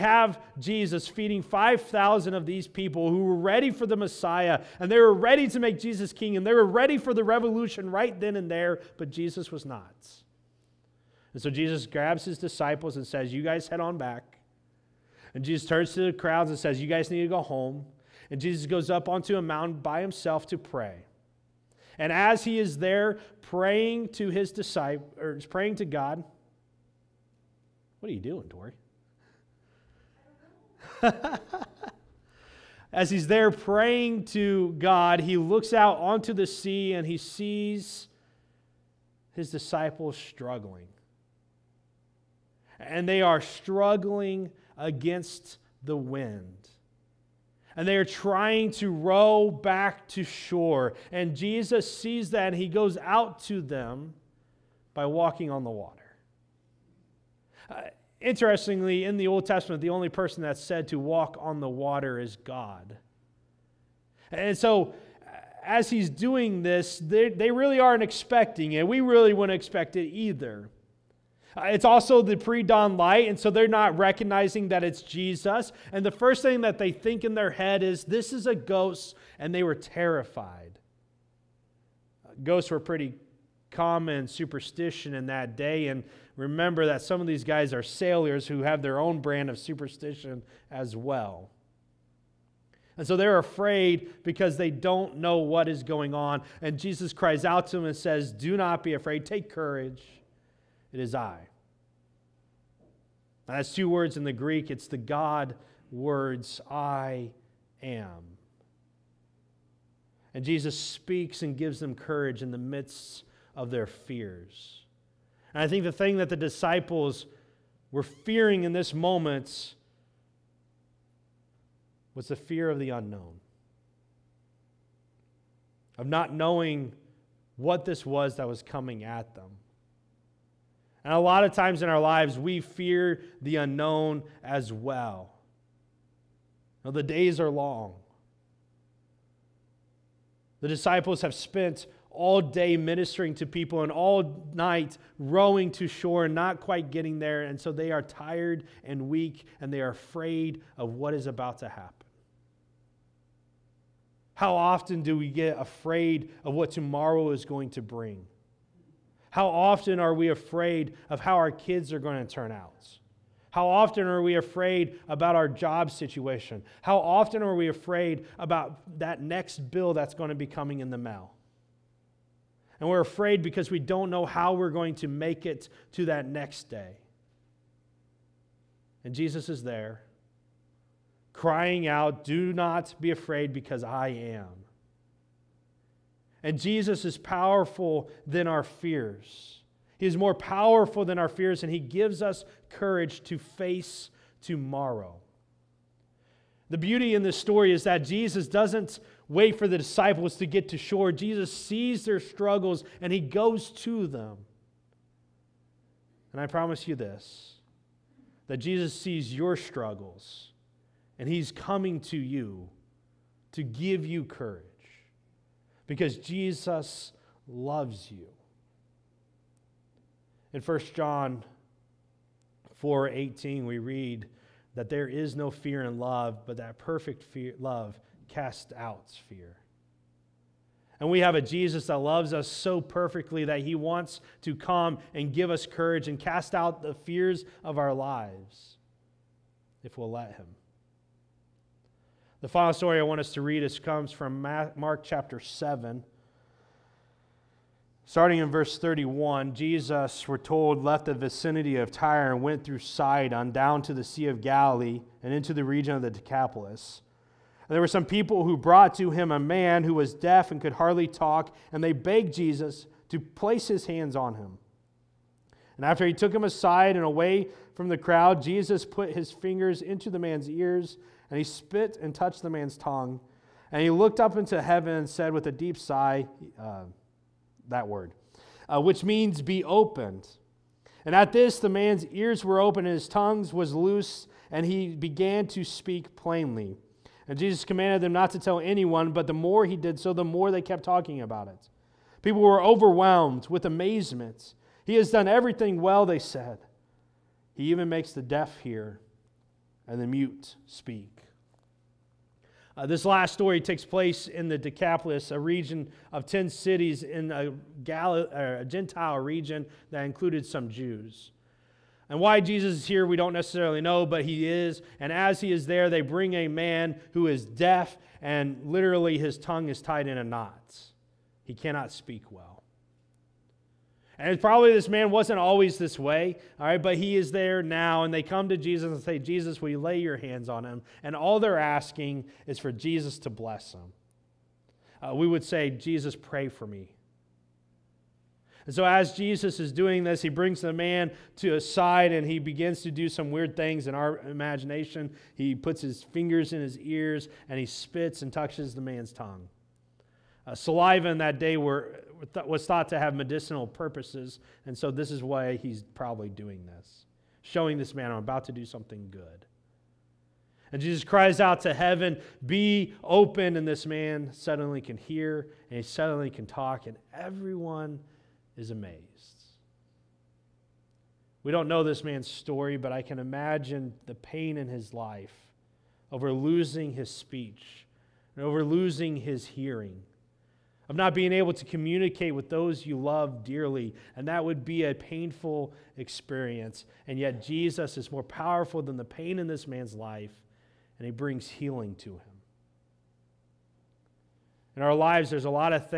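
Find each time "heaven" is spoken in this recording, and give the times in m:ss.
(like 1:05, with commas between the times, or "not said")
4:34, 6:01.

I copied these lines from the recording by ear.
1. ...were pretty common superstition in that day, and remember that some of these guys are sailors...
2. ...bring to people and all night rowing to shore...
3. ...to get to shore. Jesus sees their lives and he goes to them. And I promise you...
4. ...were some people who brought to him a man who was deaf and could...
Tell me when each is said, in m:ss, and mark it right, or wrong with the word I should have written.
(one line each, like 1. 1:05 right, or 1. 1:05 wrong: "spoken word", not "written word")
1. 1:22 right
2. 2:22 wrong: "ministering", not "bring"
3. 3:20 wrong: "struggles", not "lives"
4. 4:17 right.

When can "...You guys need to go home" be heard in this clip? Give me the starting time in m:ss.
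0:16.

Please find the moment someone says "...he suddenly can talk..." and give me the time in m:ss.
6:05.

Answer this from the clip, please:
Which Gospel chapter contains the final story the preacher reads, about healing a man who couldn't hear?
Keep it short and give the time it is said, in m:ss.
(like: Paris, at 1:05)
Mark chapter 7, at 4:04.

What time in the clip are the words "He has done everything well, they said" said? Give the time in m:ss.
4:54.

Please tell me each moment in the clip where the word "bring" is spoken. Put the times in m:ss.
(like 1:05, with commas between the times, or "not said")
2:37, 5:16, 5:40, 6:31.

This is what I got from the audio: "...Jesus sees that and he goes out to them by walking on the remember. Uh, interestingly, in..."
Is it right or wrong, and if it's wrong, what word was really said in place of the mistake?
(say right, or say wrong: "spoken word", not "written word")
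wrong: "water", not "remember".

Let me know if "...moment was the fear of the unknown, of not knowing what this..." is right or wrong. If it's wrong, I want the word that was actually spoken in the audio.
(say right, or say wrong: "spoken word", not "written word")
right.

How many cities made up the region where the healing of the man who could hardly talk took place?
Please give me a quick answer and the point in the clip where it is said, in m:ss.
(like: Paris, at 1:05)
10, at 5:06.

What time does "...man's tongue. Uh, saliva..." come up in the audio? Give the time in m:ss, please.
5:48.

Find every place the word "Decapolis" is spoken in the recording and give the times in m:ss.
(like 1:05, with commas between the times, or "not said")
4:16, 5:04.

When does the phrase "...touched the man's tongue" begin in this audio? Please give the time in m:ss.
4:32.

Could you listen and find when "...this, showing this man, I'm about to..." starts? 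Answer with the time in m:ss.
5:56.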